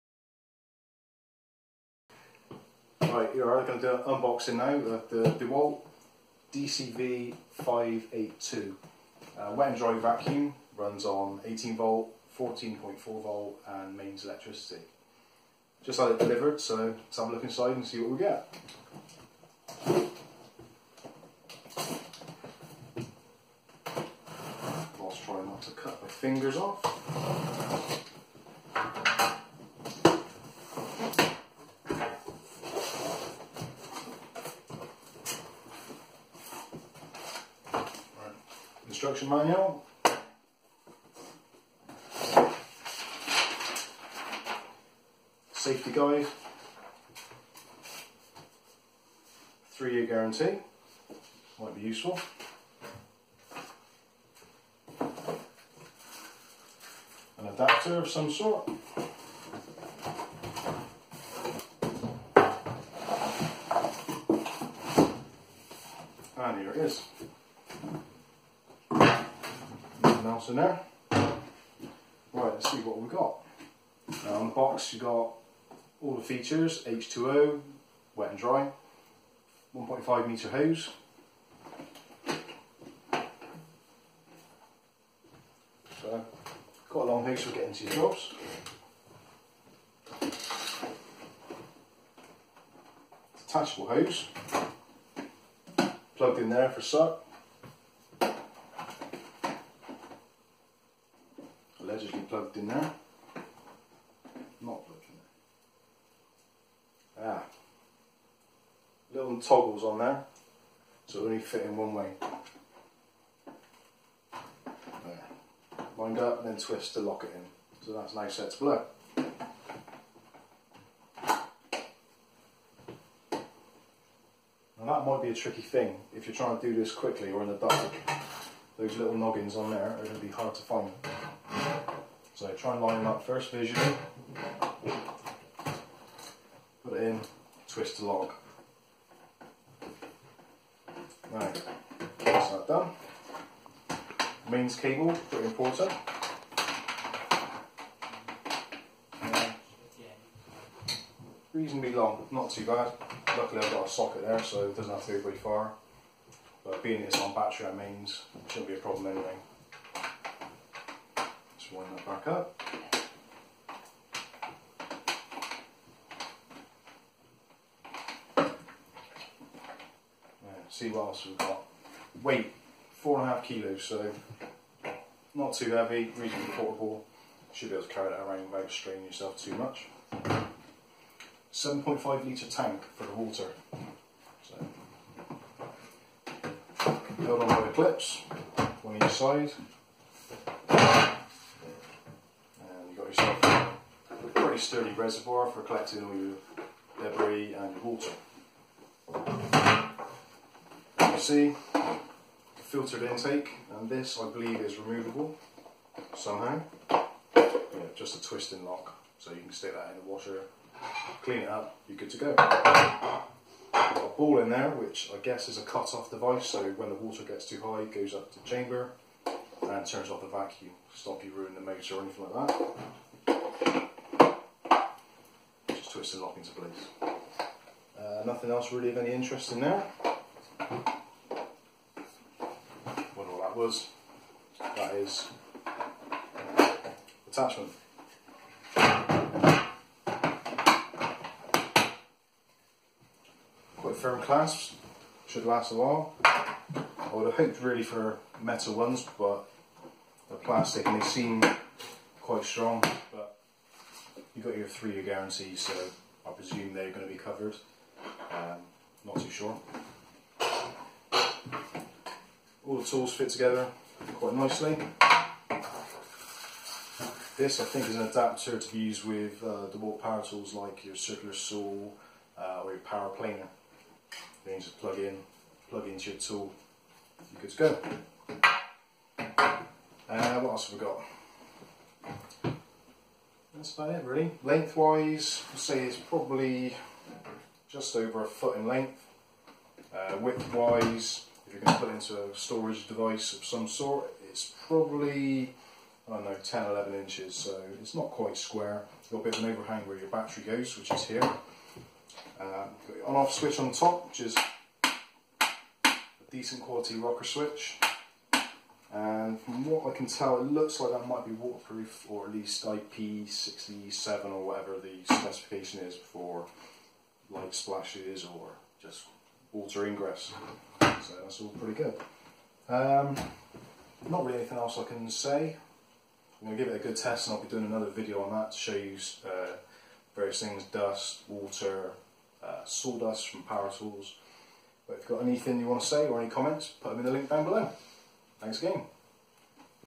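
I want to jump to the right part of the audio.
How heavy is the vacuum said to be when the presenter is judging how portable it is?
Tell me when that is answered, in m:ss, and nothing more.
2:52.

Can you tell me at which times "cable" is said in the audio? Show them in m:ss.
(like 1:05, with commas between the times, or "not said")
2:24.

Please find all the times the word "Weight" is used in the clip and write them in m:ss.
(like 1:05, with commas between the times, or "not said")
2:52.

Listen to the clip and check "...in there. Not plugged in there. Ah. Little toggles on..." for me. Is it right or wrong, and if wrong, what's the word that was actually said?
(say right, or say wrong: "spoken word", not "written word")
right.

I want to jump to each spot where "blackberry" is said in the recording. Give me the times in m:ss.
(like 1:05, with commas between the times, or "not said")
not said.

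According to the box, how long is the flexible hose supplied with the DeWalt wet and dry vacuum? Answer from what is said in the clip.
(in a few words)
1.5 metres.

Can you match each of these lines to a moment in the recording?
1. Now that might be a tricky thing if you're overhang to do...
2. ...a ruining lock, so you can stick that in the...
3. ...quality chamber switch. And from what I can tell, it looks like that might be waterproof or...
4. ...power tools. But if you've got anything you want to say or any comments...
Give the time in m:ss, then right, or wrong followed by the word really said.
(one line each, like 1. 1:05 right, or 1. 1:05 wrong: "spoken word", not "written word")
1. 2:04 wrong: "trying", not "overhang"
2. 3:28 wrong: "twisting", not "ruining"
3. 5:06 wrong: "rocker", not "chamber"
4. 5:33 right.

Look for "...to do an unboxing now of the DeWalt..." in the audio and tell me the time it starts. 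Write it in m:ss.
0:03.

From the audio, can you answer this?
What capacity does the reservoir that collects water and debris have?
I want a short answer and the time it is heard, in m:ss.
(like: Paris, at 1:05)
7.5 litres, at 3:01.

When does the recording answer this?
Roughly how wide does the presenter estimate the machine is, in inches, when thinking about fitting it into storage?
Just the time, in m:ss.
4:56.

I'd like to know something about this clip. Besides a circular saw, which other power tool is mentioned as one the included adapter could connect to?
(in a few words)
power planer.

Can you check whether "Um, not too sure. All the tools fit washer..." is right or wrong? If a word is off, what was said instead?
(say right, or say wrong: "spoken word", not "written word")
wrong: "together", not "washer".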